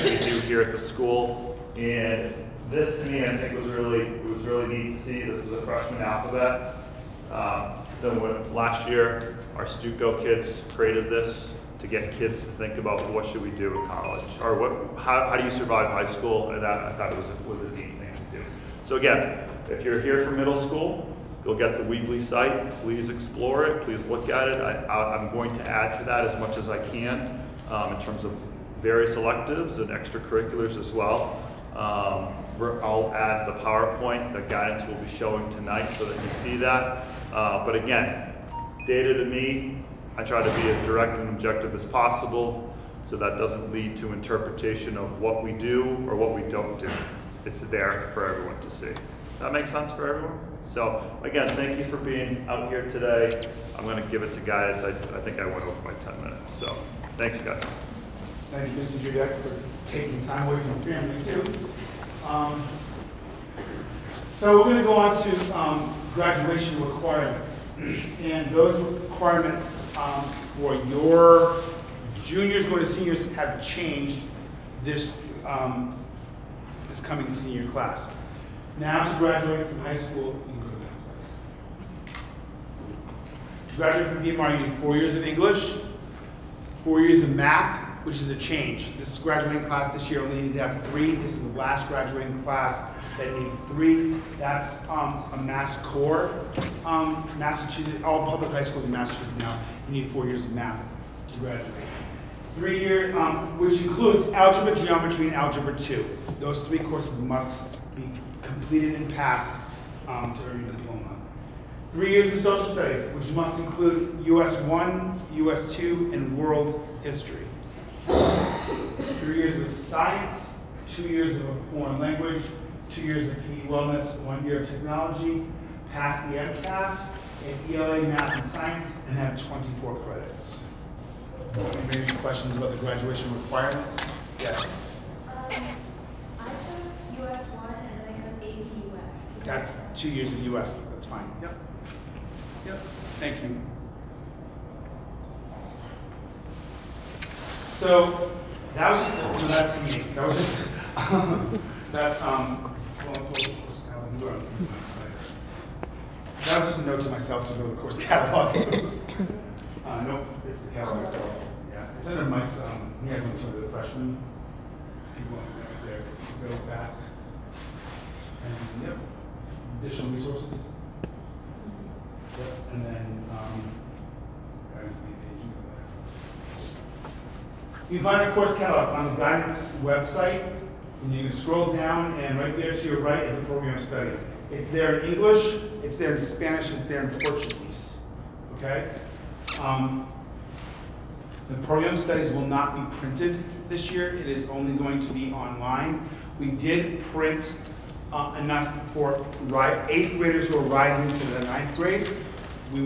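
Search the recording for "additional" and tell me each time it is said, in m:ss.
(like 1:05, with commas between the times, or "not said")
2:49.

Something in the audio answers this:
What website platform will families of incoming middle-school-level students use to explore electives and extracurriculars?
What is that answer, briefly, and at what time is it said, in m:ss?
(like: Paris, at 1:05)
Weebly, at 0:21.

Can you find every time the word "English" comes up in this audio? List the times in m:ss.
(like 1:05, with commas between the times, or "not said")
1:25, 3:05.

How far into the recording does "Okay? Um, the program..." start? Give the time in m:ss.
3:08.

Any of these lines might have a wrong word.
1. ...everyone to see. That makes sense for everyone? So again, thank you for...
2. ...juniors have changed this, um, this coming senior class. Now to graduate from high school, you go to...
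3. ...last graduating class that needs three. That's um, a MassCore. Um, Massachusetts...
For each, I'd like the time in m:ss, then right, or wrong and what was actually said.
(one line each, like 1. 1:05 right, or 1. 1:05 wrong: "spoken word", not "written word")
1. 0:48 right
2. 1:12 wrong: "seniors", not "juniors"
3. 1:31 right.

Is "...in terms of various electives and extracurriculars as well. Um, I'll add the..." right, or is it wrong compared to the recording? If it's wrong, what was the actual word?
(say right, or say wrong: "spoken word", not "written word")
right.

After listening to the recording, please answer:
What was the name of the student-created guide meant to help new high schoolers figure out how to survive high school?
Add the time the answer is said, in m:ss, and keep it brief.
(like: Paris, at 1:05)
freshman alphabet, at 0:05.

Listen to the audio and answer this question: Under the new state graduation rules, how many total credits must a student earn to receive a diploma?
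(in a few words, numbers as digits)
24.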